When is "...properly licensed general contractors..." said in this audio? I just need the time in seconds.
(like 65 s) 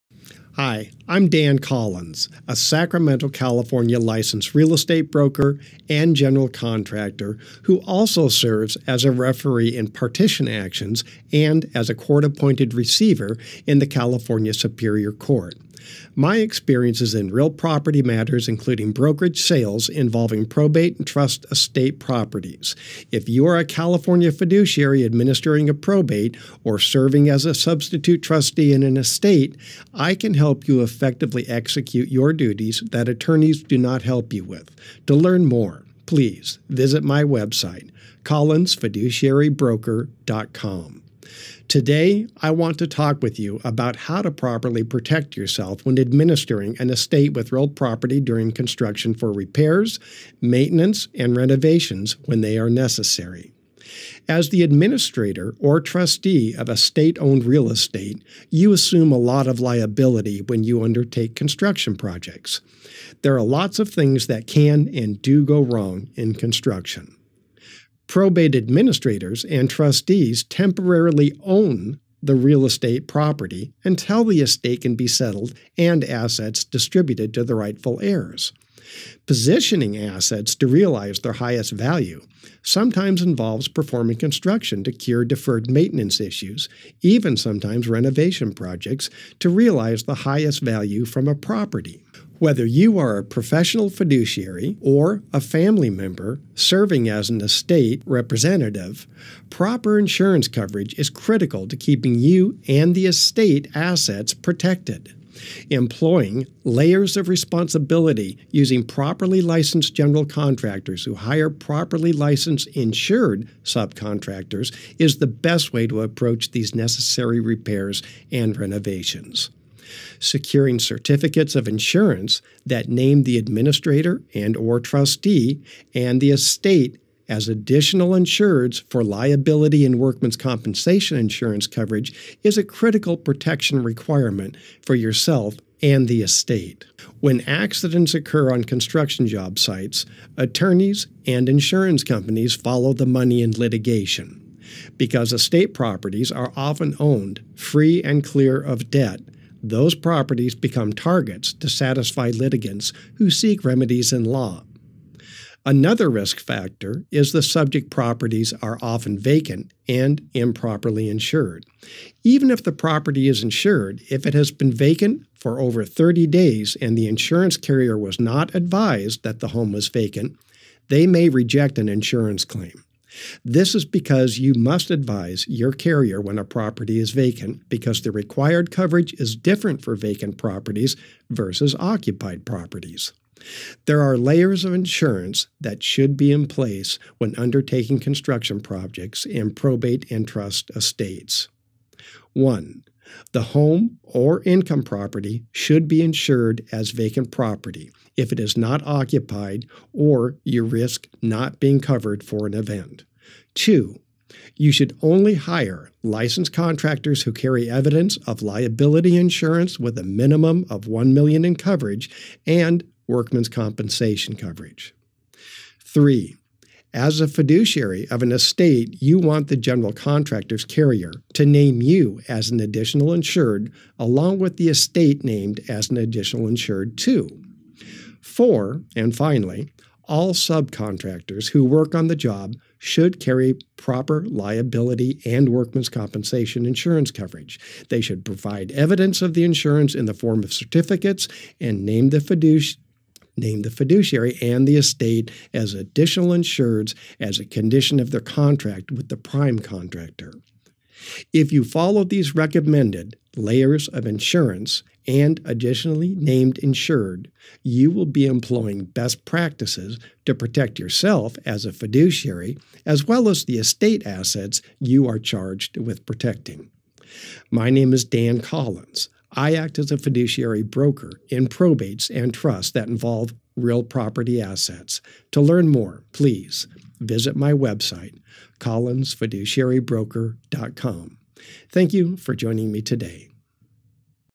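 108 s.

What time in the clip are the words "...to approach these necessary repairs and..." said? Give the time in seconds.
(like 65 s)
115 s.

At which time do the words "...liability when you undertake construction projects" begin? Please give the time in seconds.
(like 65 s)
59 s.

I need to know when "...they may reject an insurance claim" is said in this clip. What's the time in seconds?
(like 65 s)
170 s.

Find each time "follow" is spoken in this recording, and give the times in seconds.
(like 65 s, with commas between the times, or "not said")
142 s, 251 s.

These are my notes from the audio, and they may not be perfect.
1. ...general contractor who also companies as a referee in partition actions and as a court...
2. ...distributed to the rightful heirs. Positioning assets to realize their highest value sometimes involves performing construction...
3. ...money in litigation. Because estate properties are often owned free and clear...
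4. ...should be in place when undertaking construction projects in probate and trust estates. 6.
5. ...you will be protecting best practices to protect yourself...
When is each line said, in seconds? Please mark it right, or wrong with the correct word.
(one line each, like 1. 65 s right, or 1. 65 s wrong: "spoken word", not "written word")
1. 6 s wrong: "serves", not "companies"
2. 76 s right
3. 143 s right
4. 185 s wrong: "1", not "6"
5. 257 s wrong: "employing", not "protecting".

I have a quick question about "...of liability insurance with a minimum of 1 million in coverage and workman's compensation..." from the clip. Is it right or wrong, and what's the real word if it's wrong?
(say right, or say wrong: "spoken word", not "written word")
right.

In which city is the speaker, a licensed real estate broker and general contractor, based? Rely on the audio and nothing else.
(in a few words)
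Sacramento.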